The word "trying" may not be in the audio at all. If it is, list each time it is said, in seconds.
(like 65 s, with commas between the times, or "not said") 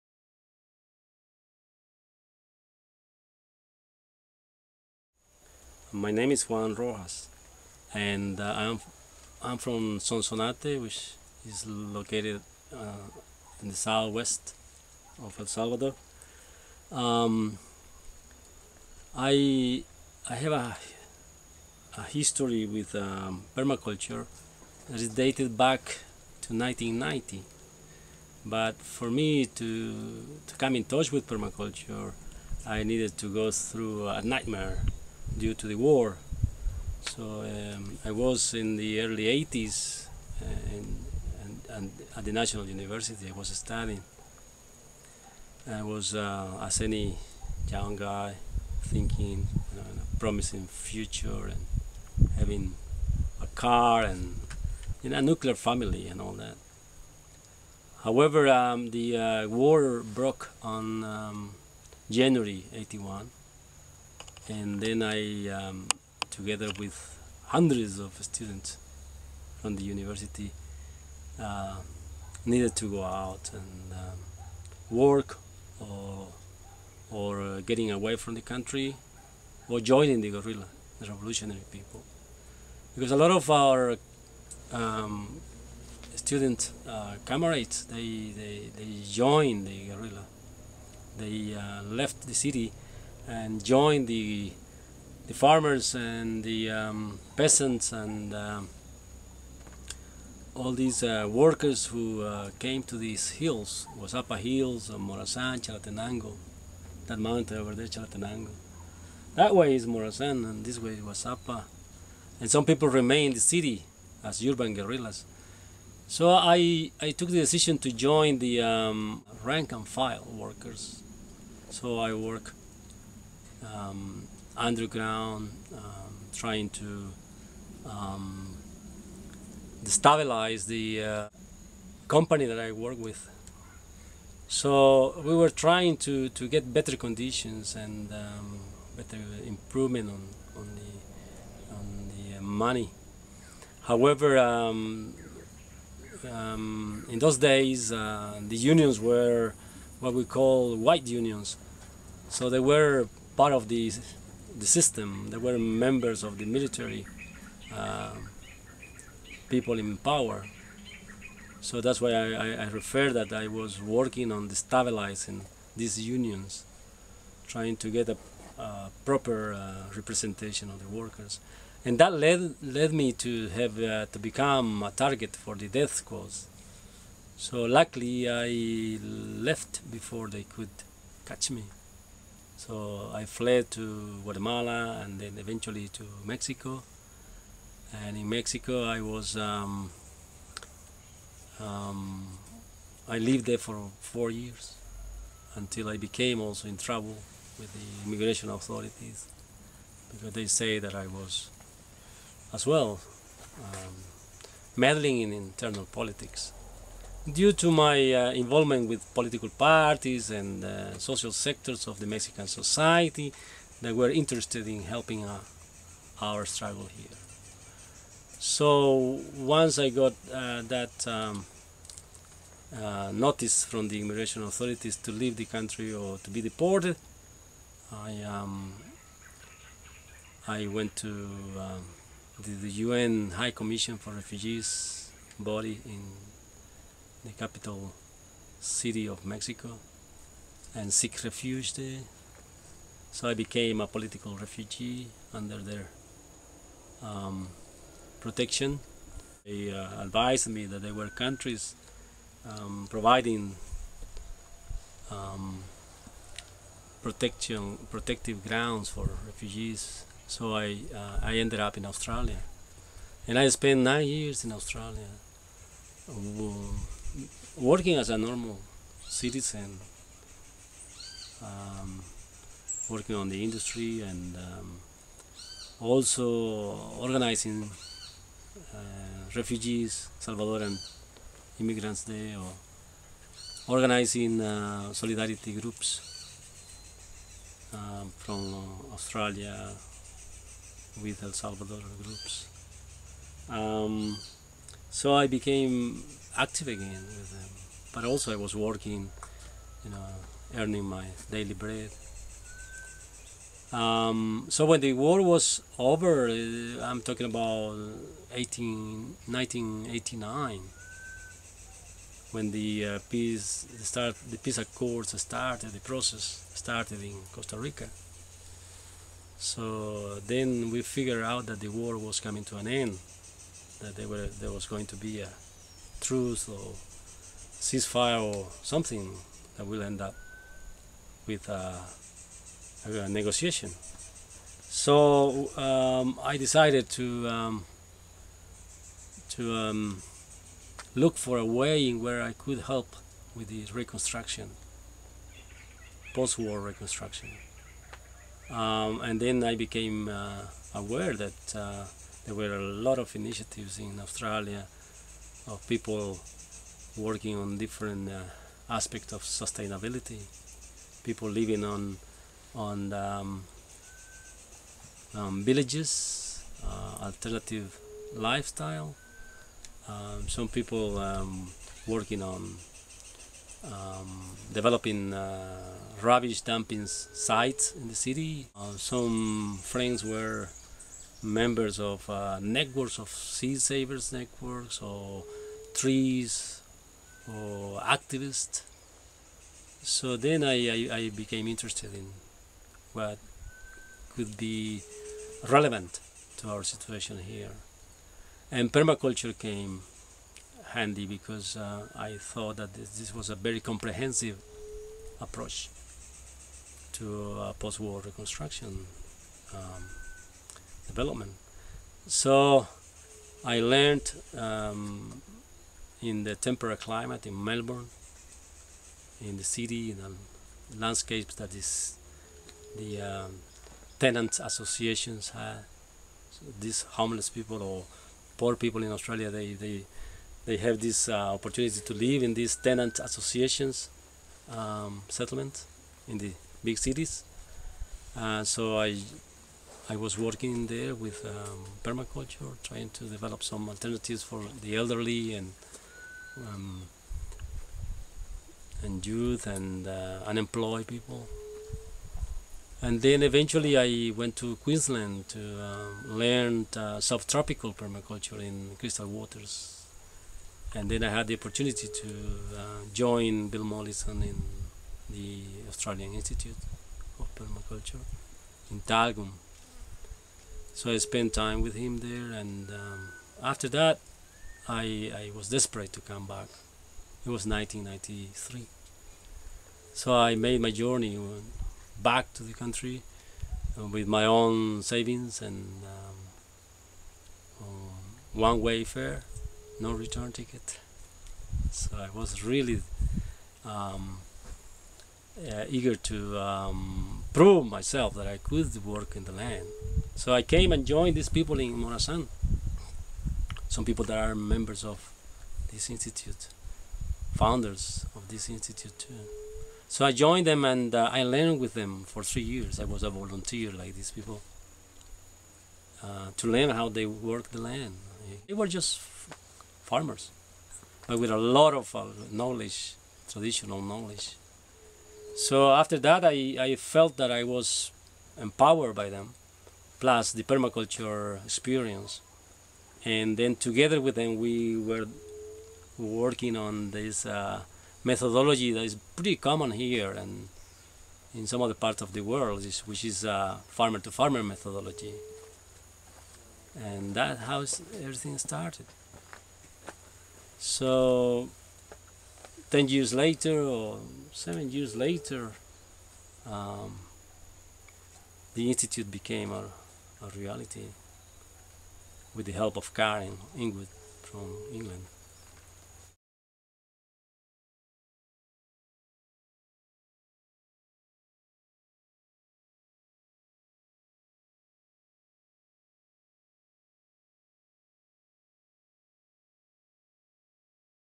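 126 s, 135 s, 167 s, 442 s.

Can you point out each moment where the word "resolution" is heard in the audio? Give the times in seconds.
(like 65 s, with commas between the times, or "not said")
not said.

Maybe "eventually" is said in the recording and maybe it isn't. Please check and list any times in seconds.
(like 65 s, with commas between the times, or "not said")
185 s, 453 s.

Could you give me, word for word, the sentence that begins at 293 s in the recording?
Um, so I became active again with them.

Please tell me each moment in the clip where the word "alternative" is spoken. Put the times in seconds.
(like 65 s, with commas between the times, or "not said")
367 s, 443 s.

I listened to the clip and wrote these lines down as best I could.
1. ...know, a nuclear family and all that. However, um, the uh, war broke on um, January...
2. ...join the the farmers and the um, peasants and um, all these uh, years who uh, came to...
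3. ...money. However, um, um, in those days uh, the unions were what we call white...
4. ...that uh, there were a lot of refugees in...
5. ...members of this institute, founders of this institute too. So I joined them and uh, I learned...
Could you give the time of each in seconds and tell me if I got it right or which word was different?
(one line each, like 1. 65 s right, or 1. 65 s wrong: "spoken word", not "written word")
1. 55 s right
2. 93 s wrong: "workers", not "years"
3. 142 s right
4. 351 s wrong: "initiatives", not "refugees"
5. 504 s right.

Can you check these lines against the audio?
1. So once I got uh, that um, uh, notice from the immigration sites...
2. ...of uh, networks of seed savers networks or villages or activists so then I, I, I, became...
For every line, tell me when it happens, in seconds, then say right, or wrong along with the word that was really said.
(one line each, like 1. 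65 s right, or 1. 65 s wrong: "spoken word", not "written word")
1. 218 s wrong: "authorities", not "sites"
2. 381 s wrong: "trees", not "villages".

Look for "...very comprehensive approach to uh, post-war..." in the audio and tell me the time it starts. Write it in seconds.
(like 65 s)
403 s.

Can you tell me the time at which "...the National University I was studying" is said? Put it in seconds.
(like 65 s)
42 s.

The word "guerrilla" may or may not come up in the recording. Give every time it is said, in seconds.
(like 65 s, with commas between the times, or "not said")
80 s, 89 s, 114 s.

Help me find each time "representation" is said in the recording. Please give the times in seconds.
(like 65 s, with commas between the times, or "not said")
169 s.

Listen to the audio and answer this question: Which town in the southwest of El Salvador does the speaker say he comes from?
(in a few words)
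Sonsonate.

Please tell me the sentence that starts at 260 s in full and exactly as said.
So I, uh, I ended up in Australia.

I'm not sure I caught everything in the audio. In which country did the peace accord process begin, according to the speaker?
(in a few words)
Costa Rica.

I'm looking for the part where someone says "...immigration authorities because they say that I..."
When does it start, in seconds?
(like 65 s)
198 s.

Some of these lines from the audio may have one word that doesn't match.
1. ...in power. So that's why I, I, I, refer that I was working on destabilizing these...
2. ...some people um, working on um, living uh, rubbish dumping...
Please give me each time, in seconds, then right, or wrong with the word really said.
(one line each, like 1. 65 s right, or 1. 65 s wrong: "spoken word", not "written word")
1. 159 s right
2. 370 s wrong: "developing", not "living".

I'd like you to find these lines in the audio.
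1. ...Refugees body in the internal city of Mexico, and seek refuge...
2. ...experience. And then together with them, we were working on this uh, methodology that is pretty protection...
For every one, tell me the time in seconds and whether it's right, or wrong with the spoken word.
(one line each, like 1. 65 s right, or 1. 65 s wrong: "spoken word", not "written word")
1. 234 s wrong: "capital", not "internal"
2. 531 s wrong: "common", not "protection".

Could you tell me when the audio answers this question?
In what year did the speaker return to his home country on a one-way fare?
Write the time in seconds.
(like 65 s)
477 s.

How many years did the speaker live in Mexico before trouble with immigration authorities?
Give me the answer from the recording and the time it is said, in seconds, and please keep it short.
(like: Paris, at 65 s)
4, at 194 s.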